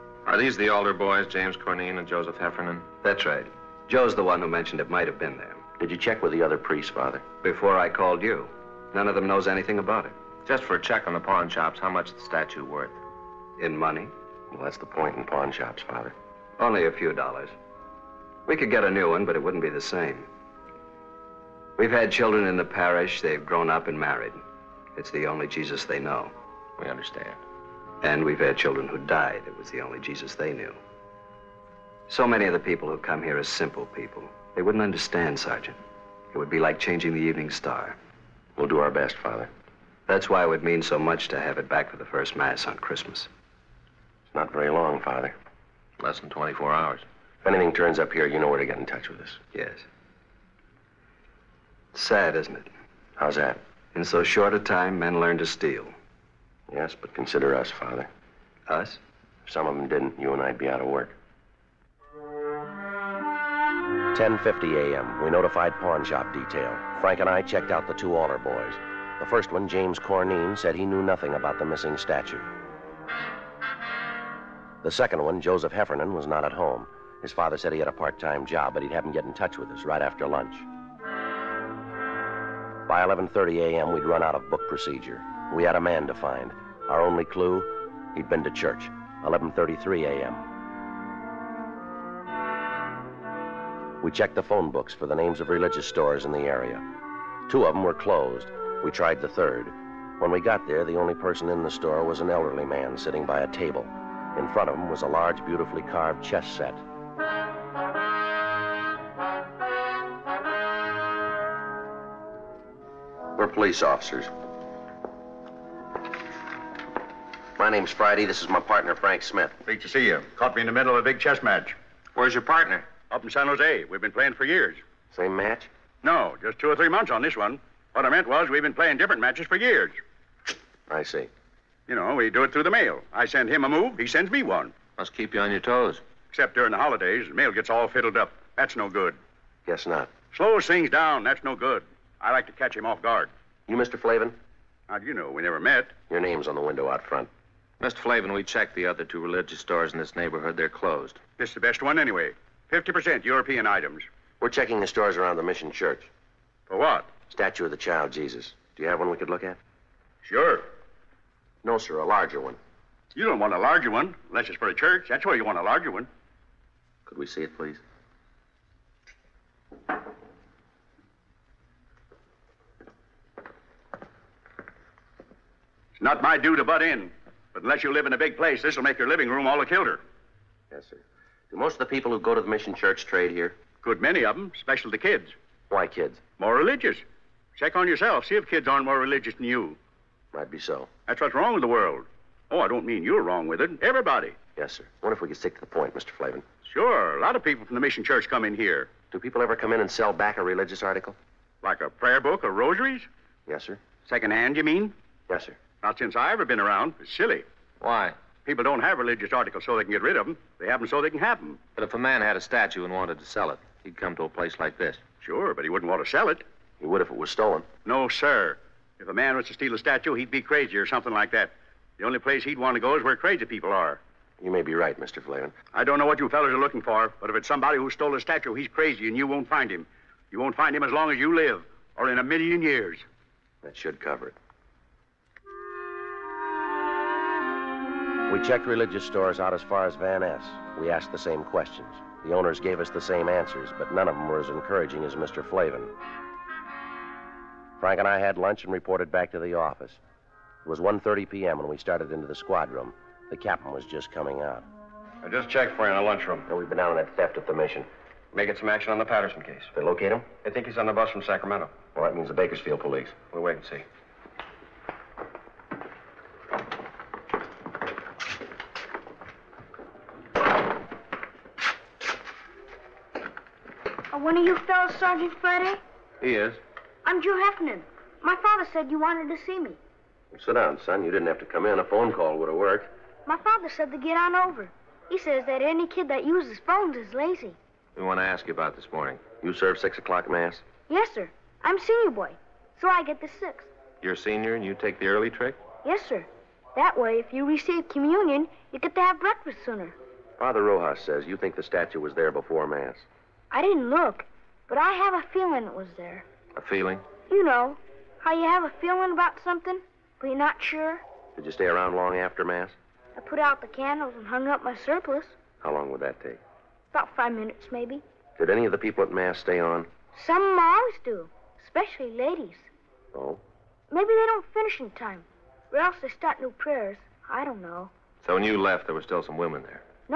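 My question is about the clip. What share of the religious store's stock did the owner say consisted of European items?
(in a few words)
50%.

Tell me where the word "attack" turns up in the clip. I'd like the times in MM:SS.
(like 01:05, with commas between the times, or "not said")
not said.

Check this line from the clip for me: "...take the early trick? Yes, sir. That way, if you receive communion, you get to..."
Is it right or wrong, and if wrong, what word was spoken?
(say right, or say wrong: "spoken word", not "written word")
right.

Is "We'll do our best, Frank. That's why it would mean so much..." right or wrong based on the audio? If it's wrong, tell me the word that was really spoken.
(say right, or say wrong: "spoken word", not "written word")
wrong: "Father", not "Frank".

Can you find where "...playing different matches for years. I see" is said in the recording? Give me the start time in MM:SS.
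02:08.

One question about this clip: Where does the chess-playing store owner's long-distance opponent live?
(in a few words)
San Jose.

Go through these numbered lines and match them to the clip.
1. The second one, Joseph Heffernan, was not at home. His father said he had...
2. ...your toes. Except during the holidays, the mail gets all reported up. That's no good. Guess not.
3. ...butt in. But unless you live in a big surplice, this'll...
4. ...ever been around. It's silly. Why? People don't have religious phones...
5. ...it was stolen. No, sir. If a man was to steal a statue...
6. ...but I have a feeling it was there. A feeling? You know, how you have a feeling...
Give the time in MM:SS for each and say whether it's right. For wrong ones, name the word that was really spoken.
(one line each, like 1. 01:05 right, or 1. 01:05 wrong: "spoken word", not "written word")
1. 01:14 right
2. 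02:15 wrong: "fiddled", not "reported"
3. 02:56 wrong: "place", not "surplice"
4. 03:26 wrong: "articles", not "phones"
5. 03:37 right
6. 05:04 right.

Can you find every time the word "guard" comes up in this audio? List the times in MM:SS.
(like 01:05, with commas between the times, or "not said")
02:23.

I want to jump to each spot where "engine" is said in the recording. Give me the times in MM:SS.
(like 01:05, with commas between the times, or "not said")
not said.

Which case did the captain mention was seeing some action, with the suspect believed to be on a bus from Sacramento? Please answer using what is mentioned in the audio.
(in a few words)
Patterson case.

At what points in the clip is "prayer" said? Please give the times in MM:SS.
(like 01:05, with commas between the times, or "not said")
03:21, 05:26.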